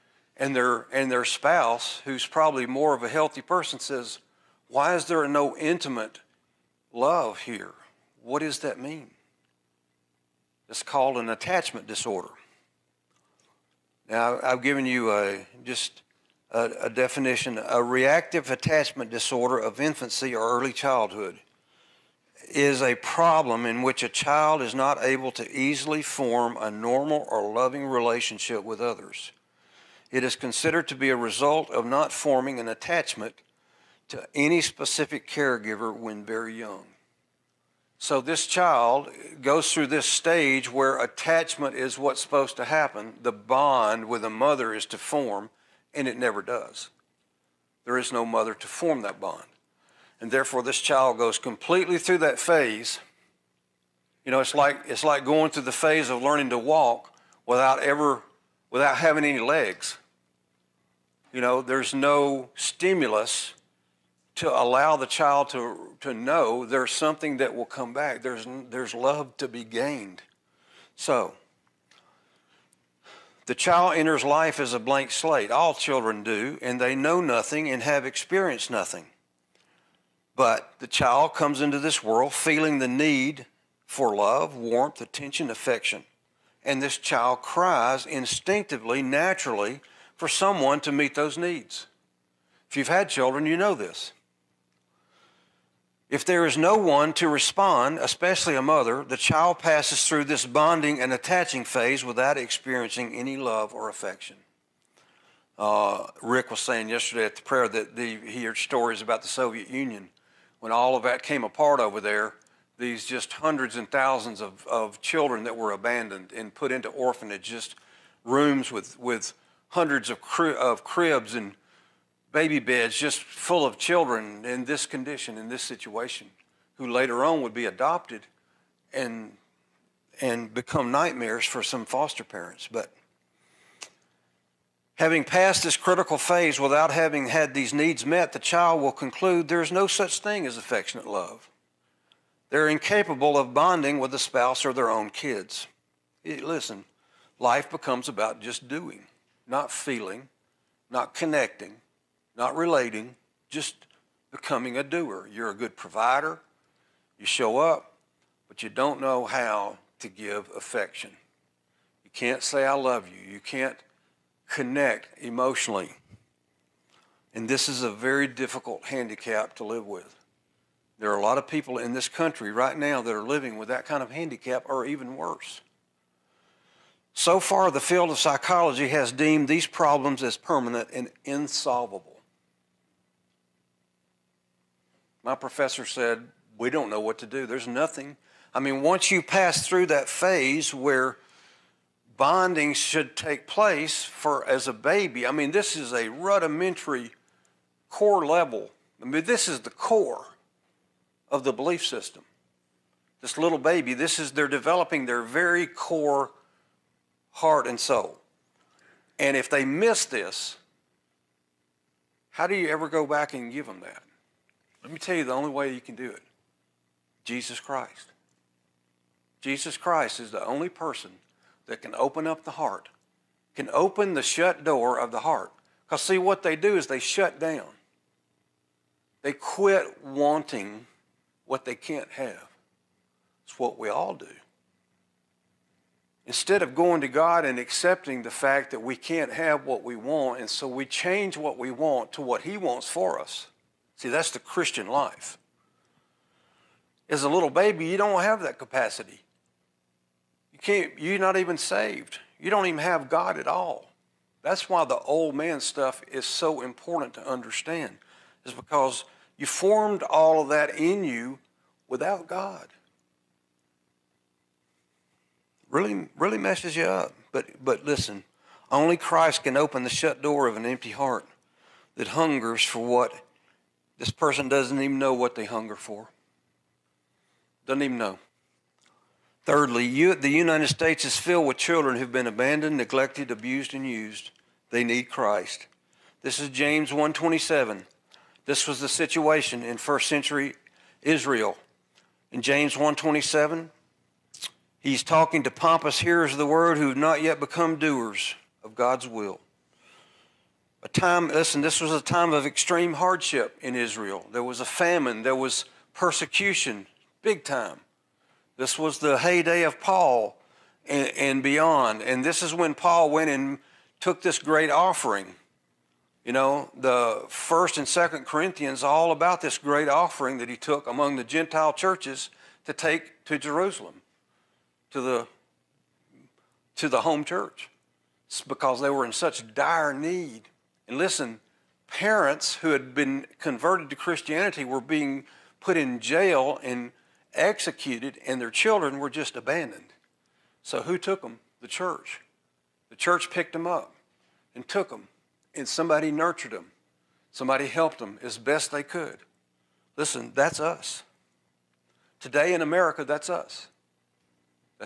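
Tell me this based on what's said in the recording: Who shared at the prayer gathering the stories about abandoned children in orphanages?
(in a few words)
Rick.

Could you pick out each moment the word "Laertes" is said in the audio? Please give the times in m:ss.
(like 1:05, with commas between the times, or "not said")
not said.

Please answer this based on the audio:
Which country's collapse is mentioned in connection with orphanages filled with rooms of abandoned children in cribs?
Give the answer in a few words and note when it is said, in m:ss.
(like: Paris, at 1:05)
Soviet Union, at 1:49.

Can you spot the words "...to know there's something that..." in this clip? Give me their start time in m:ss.
1:06.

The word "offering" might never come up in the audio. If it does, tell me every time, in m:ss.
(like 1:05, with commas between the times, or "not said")
5:14, 5:19.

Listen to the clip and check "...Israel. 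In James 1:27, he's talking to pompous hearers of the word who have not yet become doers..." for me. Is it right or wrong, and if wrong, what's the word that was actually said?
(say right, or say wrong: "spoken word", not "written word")
right.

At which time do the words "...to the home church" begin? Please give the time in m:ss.
5:26.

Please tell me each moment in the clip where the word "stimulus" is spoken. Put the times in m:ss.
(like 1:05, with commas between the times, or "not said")
1:02.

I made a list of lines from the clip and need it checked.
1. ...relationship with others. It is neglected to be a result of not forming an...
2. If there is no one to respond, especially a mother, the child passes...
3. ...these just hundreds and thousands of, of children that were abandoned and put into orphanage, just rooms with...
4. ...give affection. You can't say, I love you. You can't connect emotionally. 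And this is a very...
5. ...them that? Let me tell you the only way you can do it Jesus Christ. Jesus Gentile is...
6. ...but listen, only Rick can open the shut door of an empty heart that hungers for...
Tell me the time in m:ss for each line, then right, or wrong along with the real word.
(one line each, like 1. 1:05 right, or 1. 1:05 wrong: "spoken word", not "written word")
1. 0:27 wrong: "considered", not "neglected"
2. 1:36 right
3. 1:52 right
4. 2:40 right
5. 3:33 wrong: "Christ", not "Gentile"
6. 4:27 wrong: "Christ", not "Rick".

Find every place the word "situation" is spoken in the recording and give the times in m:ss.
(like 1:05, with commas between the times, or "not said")
2:05, 4:48.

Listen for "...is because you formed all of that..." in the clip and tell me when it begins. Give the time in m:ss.
4:18.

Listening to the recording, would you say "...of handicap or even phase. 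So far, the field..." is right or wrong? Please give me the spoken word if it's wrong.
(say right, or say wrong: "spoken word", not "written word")
wrong: "worse", not "phase".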